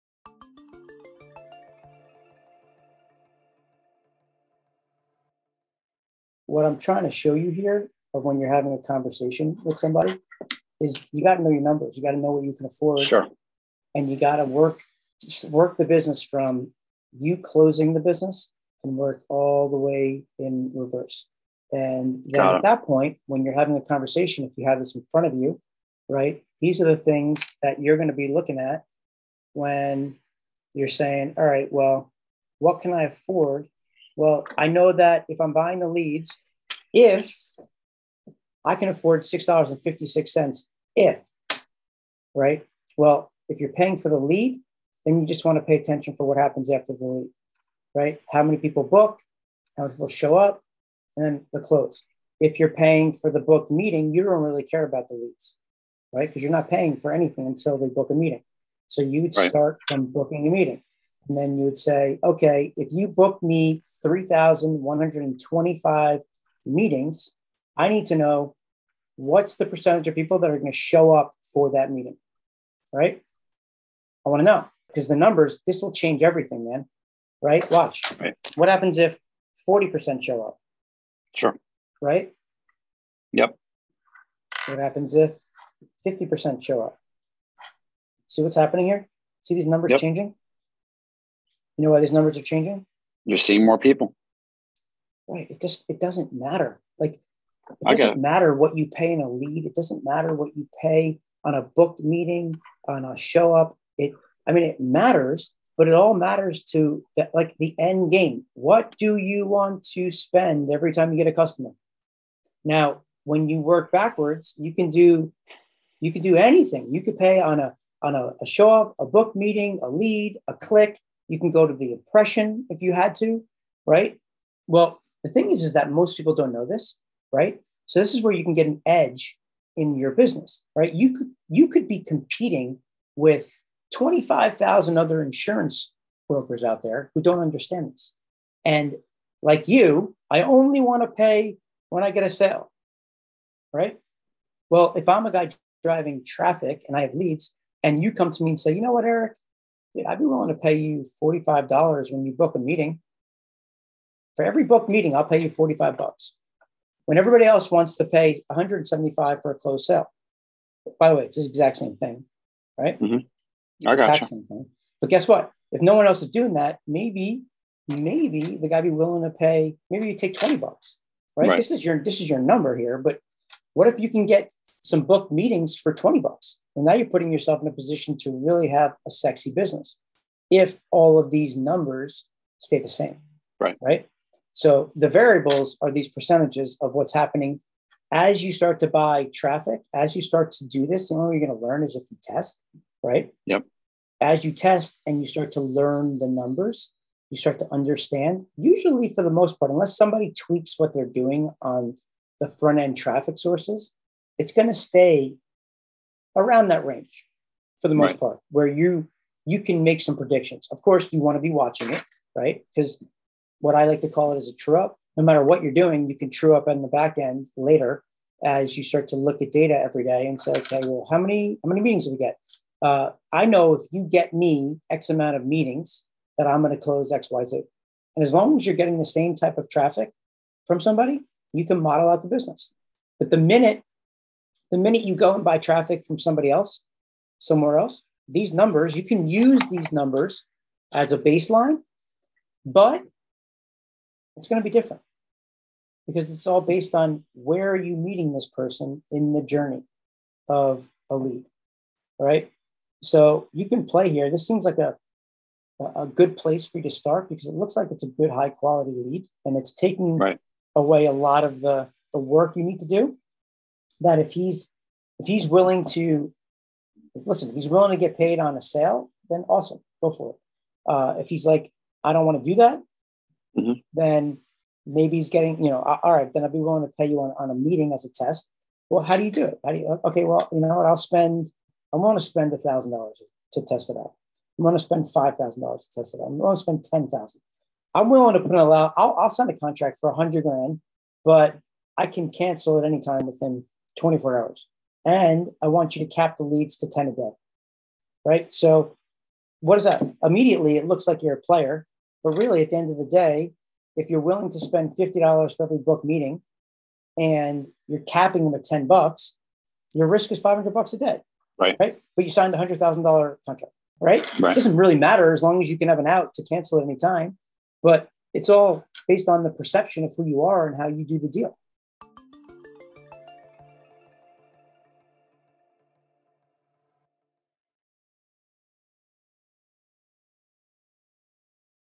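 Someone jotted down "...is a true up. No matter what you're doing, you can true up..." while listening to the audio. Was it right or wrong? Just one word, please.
right.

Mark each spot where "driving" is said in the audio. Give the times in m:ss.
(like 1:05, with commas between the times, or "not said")
2:25.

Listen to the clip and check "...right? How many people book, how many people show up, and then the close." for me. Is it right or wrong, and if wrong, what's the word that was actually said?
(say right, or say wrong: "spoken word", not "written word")
right.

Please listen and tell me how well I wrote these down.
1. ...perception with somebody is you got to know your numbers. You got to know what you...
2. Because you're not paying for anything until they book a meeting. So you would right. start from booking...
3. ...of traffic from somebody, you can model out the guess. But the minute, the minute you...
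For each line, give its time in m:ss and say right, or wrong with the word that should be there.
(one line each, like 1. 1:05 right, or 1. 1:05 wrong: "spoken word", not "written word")
1. 0:08 wrong: "conversation", not "perception"
2. 0:56 right
3. 3:49 wrong: "business", not "guess".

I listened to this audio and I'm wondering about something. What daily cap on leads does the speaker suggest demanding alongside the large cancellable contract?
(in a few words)
10 a day.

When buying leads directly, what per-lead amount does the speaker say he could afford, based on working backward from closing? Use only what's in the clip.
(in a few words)
$6.56.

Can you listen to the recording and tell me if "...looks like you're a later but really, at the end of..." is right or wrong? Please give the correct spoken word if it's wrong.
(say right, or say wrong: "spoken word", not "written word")
wrong: "player", not "later".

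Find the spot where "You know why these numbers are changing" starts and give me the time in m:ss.
1:31.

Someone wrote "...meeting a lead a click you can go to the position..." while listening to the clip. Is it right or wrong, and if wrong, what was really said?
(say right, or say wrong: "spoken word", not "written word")
wrong: "impression", not "position".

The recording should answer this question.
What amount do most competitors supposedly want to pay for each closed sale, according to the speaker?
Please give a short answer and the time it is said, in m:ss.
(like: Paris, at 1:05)
$175, at 2:38.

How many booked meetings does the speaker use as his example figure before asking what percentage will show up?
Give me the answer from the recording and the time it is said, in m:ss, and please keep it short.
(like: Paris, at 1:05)
3,125, at 1:04.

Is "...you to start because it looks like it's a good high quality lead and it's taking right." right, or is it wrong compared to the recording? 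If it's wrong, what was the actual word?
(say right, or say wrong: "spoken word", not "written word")
right.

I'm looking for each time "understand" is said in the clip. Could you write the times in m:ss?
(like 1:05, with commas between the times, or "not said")
2:17, 3:17.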